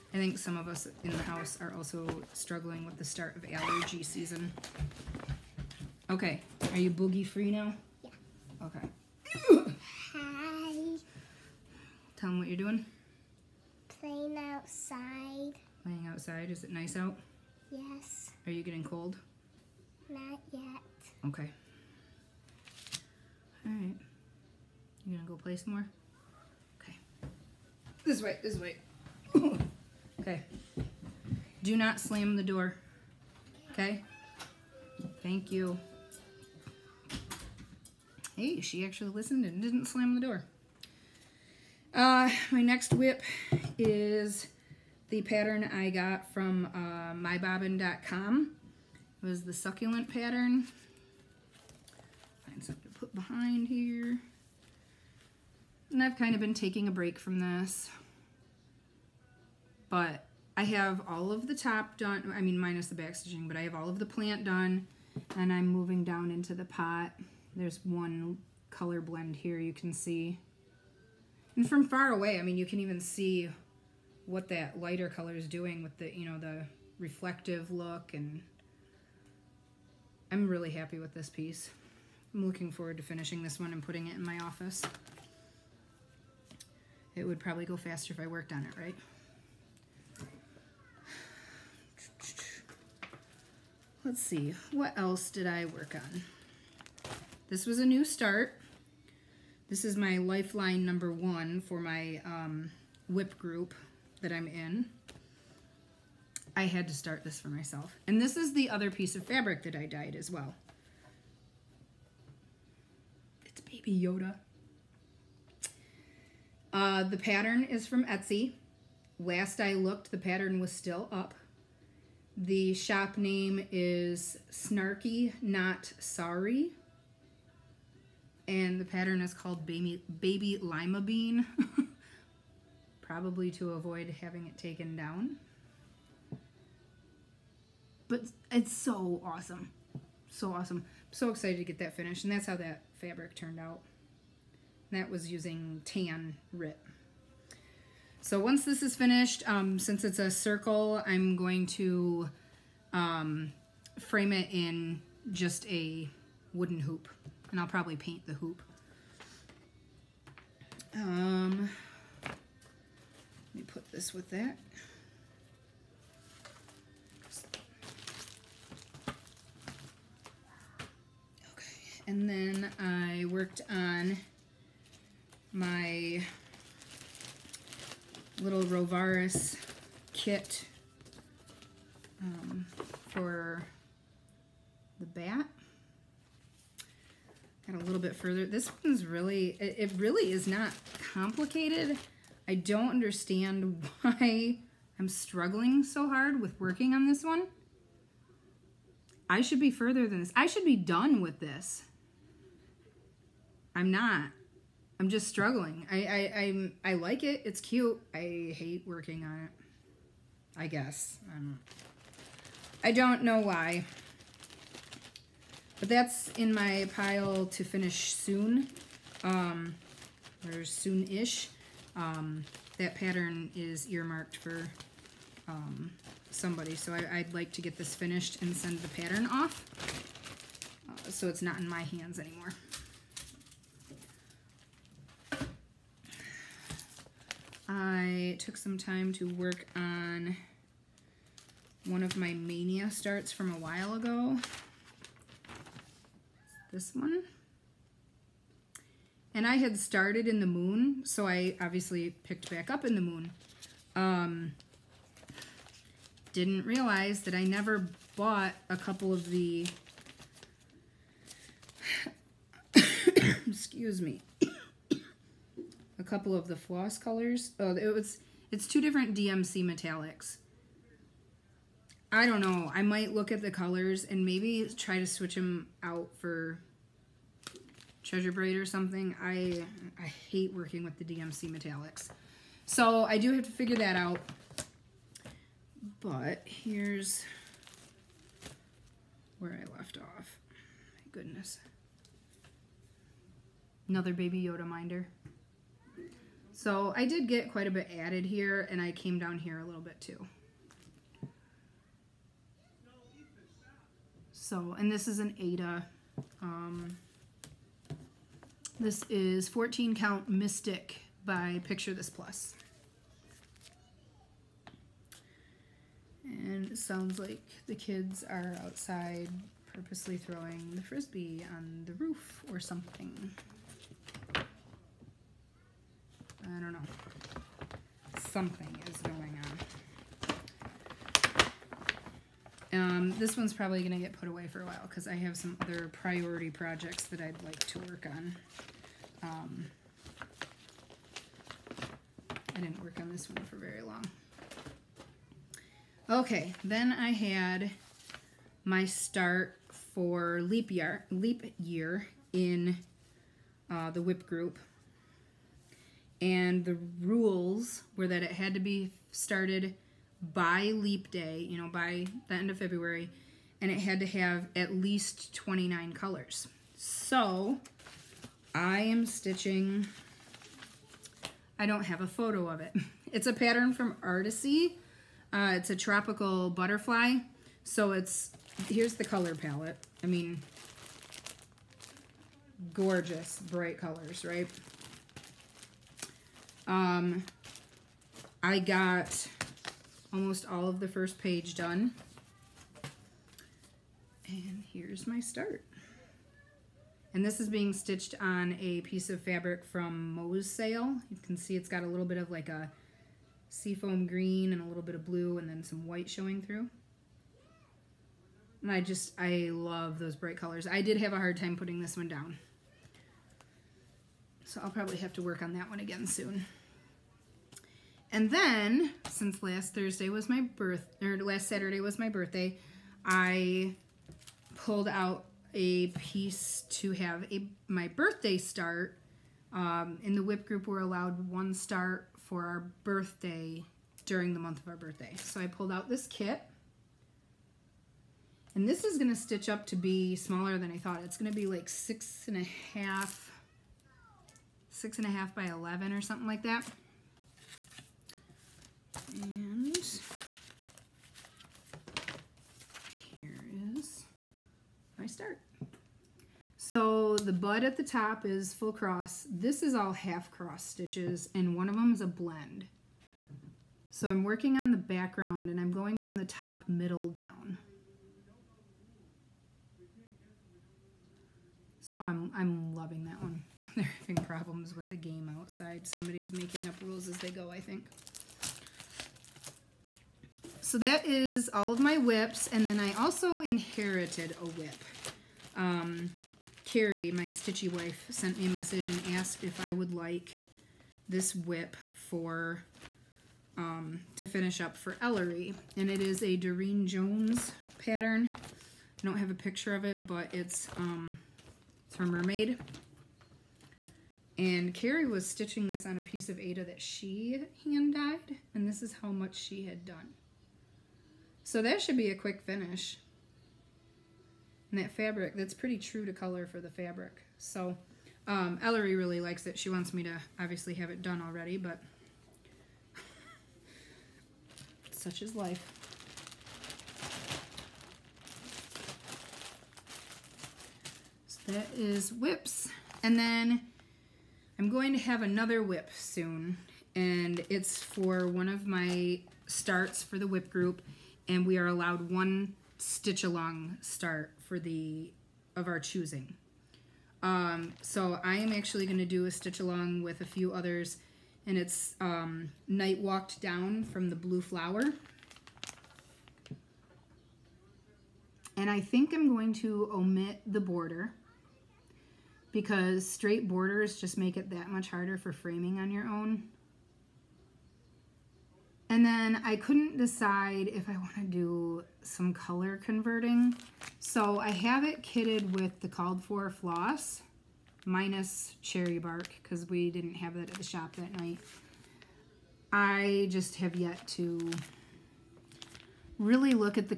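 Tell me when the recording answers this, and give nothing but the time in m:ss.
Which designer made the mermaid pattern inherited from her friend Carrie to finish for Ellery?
8:16.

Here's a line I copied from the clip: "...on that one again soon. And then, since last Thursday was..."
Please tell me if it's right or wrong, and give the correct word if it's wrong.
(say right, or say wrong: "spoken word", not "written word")
right.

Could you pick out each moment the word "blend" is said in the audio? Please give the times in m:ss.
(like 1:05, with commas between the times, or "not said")
1:08, 7:42.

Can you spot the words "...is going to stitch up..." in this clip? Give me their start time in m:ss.
7:18.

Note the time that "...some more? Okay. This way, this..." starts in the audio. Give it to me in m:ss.
0:25.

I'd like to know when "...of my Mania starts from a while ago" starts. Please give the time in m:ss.
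4:02.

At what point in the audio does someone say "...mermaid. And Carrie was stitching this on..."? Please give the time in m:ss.
8:22.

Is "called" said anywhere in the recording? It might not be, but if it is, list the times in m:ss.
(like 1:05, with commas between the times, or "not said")
2:09, 9:35.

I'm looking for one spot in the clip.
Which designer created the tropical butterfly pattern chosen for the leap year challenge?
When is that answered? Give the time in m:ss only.
6:14.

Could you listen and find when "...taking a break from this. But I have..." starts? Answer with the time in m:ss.
0:56.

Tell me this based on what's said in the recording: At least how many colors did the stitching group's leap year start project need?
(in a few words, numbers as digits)
29.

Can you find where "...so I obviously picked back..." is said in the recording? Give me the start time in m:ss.
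4:11.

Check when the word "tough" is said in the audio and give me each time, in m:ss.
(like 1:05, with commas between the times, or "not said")
not said.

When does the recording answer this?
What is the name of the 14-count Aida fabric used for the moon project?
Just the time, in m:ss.
5:09.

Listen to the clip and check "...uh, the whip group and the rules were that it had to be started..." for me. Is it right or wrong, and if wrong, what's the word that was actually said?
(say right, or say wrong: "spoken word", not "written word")
right.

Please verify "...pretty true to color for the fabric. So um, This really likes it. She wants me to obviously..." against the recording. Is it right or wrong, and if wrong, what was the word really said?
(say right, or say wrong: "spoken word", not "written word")
wrong: "Ellery", not "This".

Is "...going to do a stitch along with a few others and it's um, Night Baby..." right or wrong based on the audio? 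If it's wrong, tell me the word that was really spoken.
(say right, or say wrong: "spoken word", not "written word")
wrong: "Walked", not "Baby".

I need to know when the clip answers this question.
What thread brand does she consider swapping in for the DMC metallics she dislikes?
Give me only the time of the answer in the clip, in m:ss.
4:38.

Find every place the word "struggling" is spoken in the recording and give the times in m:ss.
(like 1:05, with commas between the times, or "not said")
0:02, 3:15, 3:25.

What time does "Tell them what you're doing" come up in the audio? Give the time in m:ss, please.
0:12.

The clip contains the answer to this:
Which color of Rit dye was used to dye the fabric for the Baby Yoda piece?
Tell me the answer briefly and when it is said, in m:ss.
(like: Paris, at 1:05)
Tan, at 2:25.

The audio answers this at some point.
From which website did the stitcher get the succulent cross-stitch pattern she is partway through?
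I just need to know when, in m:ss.
0:47.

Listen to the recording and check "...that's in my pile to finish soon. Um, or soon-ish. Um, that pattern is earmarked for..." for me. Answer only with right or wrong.
right.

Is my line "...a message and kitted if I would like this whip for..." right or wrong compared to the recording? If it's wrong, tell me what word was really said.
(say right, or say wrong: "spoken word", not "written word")
wrong: "asked", not "kitted".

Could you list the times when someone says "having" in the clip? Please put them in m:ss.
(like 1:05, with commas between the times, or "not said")
2:14, 7:54.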